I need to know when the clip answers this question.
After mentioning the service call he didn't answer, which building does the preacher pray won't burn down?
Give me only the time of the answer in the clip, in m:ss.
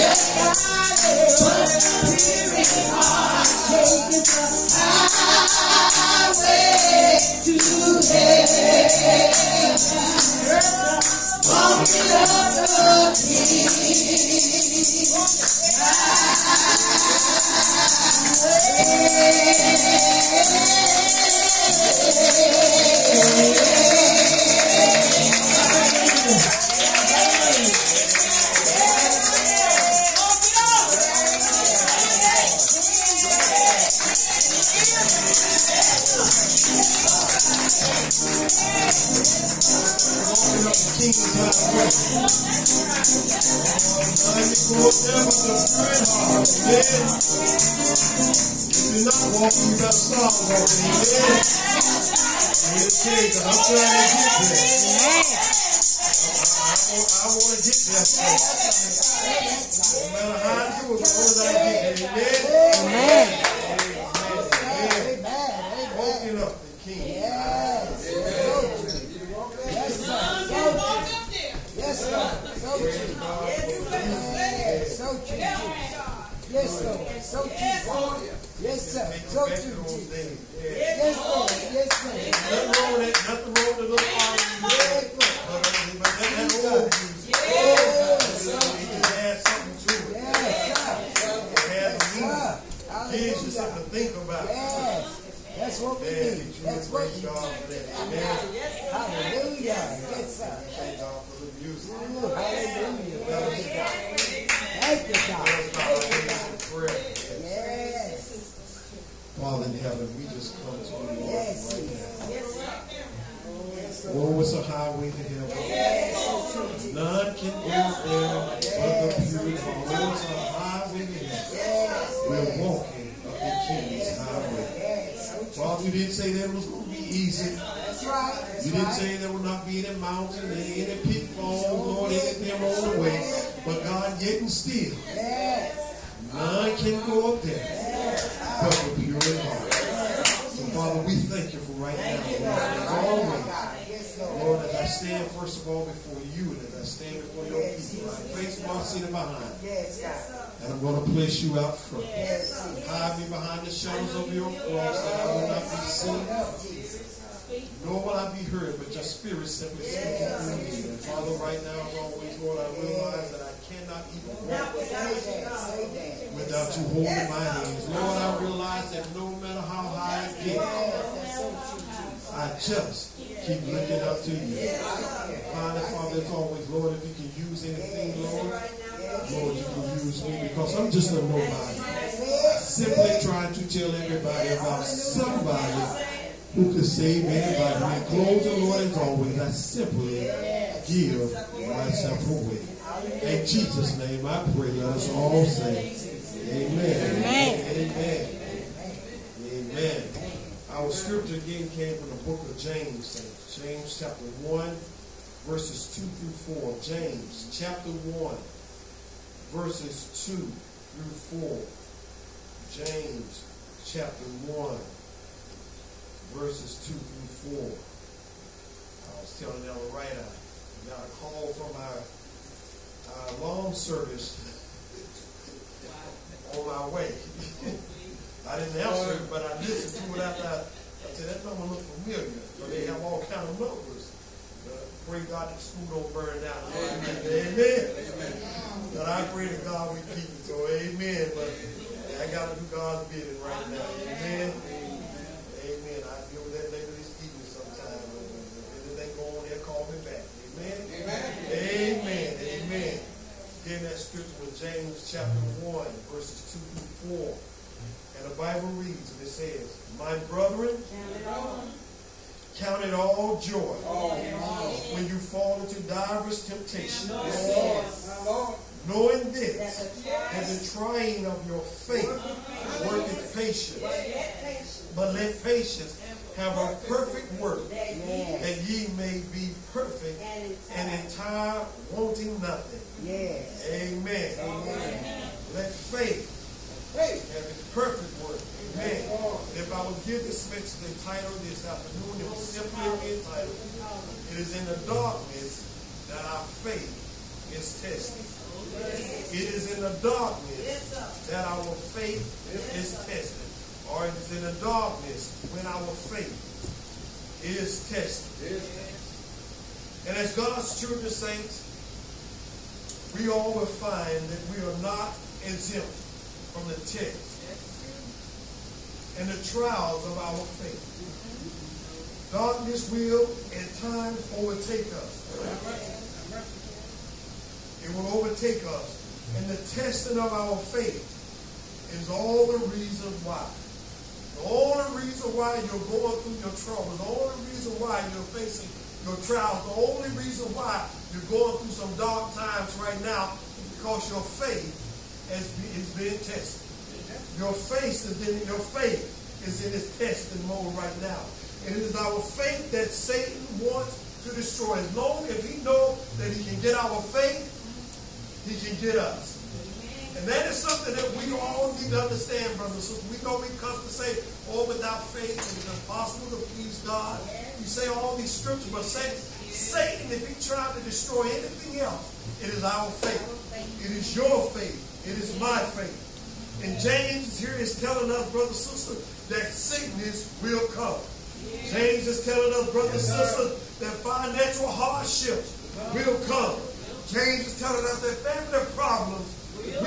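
3:55.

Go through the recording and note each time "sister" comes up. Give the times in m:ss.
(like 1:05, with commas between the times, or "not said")
6:18, 6:23.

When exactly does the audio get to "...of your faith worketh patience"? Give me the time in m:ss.
4:31.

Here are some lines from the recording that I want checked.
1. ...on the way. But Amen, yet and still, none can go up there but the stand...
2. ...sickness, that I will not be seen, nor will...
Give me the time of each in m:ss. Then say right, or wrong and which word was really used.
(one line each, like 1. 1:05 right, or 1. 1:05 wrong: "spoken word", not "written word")
1. 2:12 wrong: "God", not "Amen"
2. 2:34 wrong: "cross", not "sickness".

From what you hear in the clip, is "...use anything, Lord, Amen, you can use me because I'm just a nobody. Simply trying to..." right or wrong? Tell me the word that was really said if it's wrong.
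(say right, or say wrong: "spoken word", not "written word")
wrong: "Lord", not "Amen".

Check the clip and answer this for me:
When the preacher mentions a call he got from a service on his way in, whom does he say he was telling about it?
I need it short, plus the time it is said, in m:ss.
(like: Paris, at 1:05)
Ella, at 3:39.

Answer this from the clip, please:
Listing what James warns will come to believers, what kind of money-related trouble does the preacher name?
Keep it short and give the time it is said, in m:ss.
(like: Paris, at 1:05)
financial hardships, at 6:24.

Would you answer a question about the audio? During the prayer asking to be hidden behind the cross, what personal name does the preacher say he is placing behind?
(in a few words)
Marsena.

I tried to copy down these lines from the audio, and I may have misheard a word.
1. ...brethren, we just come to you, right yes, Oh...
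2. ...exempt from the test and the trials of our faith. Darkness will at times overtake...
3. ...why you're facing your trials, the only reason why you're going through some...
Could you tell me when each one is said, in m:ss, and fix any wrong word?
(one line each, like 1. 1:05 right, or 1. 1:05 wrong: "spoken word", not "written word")
1. 1:49 wrong: "heaven", not "brethren"
2. 5:15 right
3. 5:37 right.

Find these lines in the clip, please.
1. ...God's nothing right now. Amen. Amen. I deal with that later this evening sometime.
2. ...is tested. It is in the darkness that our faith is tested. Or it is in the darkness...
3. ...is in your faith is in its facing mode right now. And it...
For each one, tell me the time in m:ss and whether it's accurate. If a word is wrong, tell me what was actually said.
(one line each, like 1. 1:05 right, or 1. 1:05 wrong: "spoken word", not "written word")
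1. 4:02 wrong: "bidding", not "nothing"
2. 4:57 right
3. 5:48 wrong: "testing", not "facing".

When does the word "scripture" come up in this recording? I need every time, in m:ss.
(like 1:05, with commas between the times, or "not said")
3:20, 4:13, 6:08.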